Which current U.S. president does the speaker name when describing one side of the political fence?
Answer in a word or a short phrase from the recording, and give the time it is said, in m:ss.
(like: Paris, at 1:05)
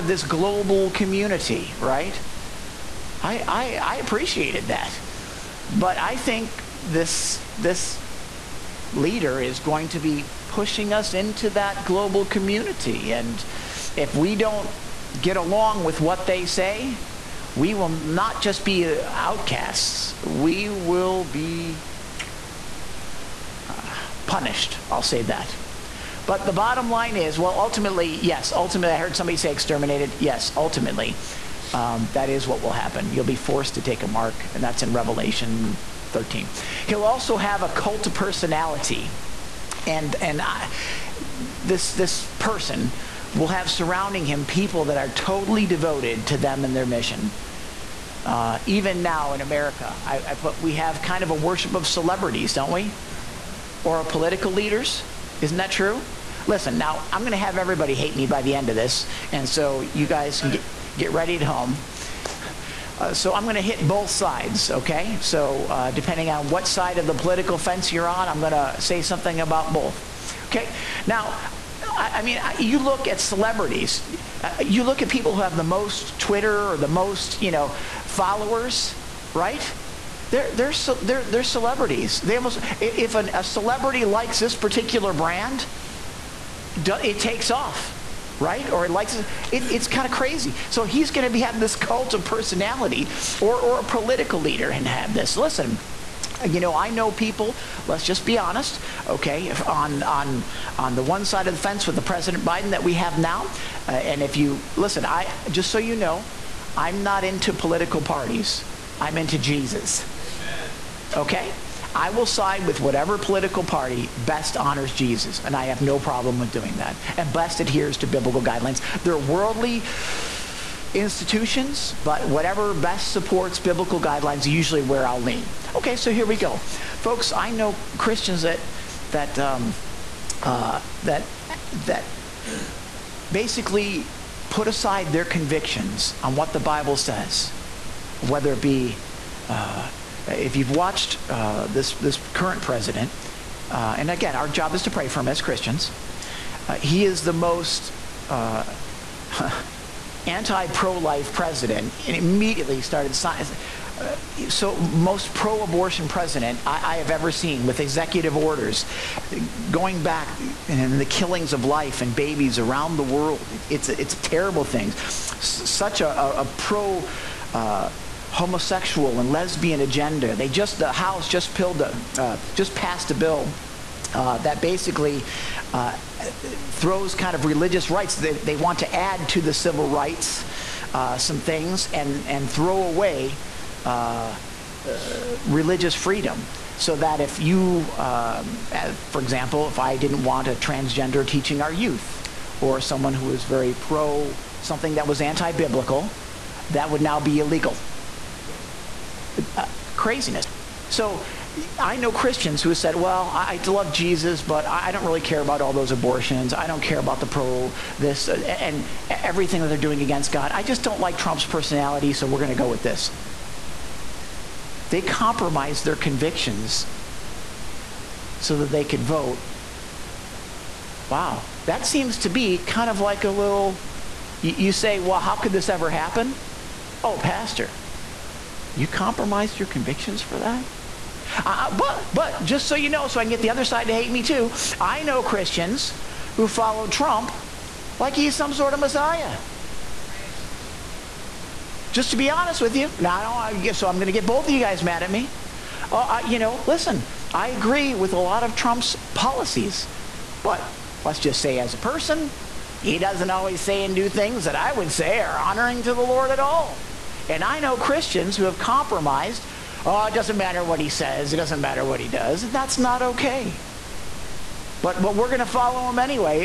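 Biden, at 1:42.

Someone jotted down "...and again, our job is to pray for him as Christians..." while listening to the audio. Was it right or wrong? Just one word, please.
right.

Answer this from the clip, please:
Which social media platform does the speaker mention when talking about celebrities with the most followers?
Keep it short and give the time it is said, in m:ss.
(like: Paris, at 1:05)
Twitter, at 1:16.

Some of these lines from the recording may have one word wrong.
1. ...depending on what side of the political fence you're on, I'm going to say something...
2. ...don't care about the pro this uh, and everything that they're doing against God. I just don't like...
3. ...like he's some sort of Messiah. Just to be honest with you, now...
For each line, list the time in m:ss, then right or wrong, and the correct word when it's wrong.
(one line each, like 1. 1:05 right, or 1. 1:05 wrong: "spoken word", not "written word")
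1. 1:05 right
2. 3:26 right
3. 3:57 right.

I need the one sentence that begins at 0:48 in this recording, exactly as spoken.
Uh, even now in America, I, I, put we have kind of a worship of celebrities, don't we?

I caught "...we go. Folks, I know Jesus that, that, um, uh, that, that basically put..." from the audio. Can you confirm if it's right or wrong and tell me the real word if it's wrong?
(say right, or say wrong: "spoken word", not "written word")
wrong: "Christians", not "Jesus".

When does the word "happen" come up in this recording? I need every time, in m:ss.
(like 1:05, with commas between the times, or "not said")
0:32, 3:45.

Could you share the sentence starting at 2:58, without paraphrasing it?
They, they, want to add to the civil rights uh, some things and and throw away.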